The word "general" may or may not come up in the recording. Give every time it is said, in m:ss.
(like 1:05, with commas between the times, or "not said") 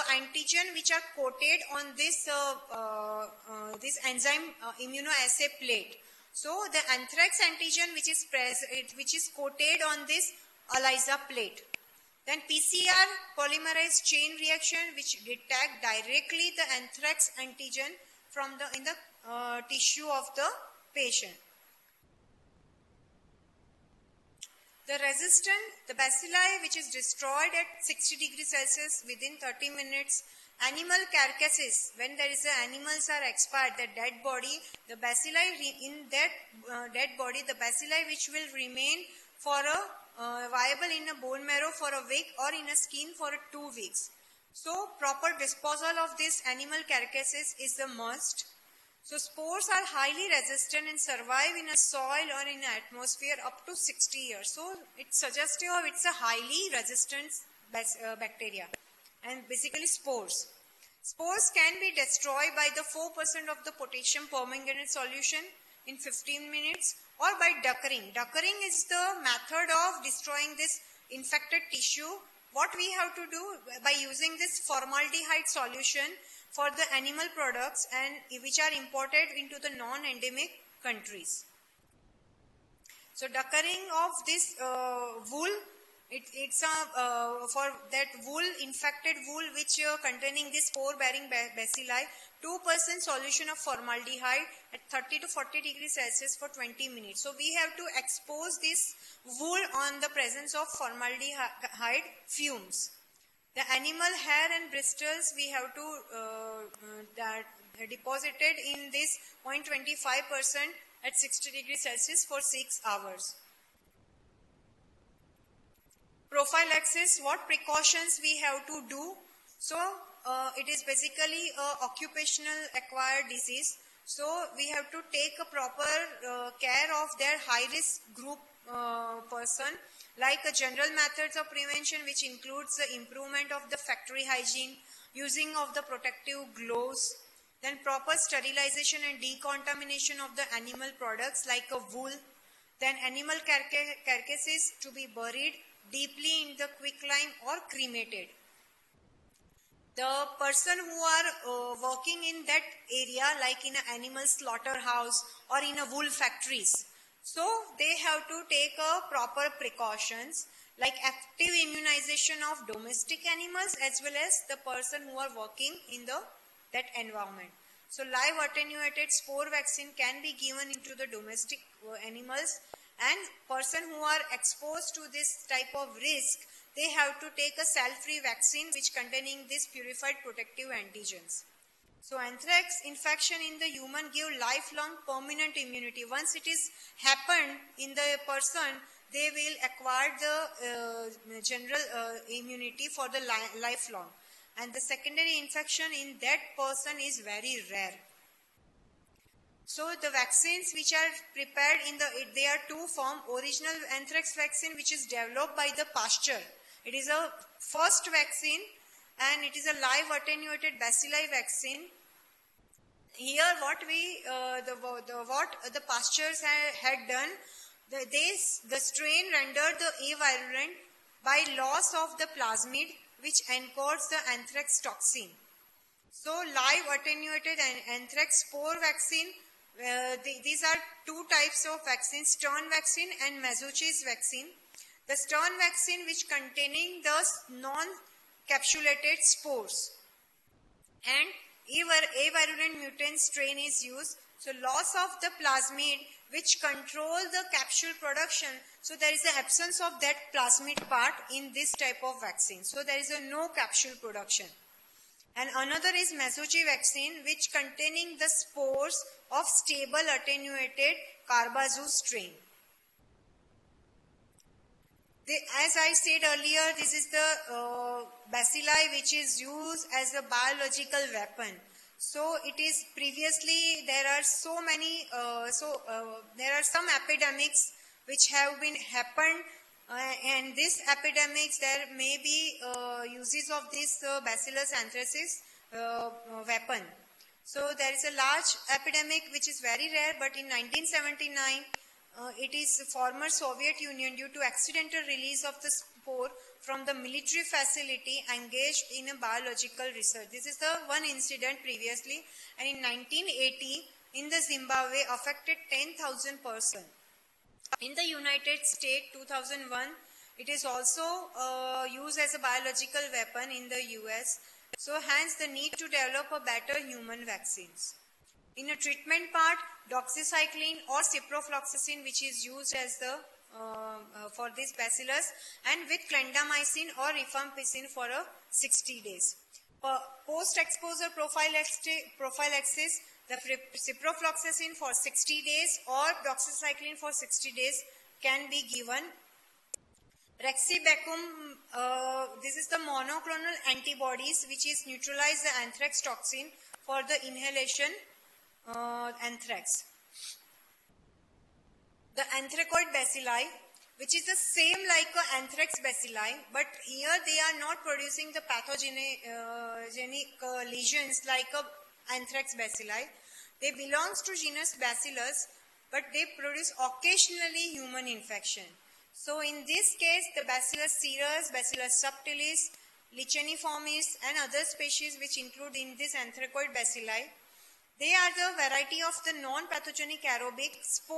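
2:10, 3:11.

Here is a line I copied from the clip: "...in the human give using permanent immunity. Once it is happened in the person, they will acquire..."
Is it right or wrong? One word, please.
wrong.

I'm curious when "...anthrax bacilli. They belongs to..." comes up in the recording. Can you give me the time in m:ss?
6:02.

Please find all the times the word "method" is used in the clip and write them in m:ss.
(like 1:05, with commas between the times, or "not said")
1:09, 2:10.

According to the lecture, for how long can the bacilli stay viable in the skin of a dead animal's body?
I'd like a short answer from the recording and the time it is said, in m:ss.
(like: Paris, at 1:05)
2 weeks, at 0:43.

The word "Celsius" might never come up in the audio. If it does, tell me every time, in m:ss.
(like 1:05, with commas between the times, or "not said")
0:28, 1:35, 1:51.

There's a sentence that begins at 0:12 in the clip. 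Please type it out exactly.
Then PCR polymerase chain reaction which detect directly the anthrax antigen from the in the uh, tissue of the patient.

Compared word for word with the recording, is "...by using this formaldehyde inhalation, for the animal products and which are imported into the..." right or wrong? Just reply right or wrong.
wrong.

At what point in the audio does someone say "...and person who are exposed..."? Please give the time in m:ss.
2:52.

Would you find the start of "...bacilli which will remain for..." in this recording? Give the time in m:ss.
0:37.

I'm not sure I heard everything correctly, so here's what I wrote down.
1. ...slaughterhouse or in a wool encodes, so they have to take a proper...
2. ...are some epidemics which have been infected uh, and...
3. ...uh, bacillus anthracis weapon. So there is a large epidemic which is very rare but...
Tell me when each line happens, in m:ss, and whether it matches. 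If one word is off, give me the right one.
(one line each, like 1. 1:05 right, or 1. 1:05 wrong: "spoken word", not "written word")
1. 2:34 wrong: "factories", not "encodes"
2. 4:36 wrong: "happened", not "infected"
3. 4:44 right.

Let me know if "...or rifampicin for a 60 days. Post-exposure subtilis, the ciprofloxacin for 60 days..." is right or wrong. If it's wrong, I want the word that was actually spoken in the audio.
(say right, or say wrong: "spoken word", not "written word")
wrong: "prophylaxis", not "subtilis".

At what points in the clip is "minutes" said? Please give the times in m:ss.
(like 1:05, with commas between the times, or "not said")
0:29, 1:06, 1:36.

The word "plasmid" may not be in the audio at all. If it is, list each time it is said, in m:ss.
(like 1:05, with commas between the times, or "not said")
3:42, 4:05, 4:10.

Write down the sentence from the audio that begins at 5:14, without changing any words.
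So hence the need to develop a better human vaccines.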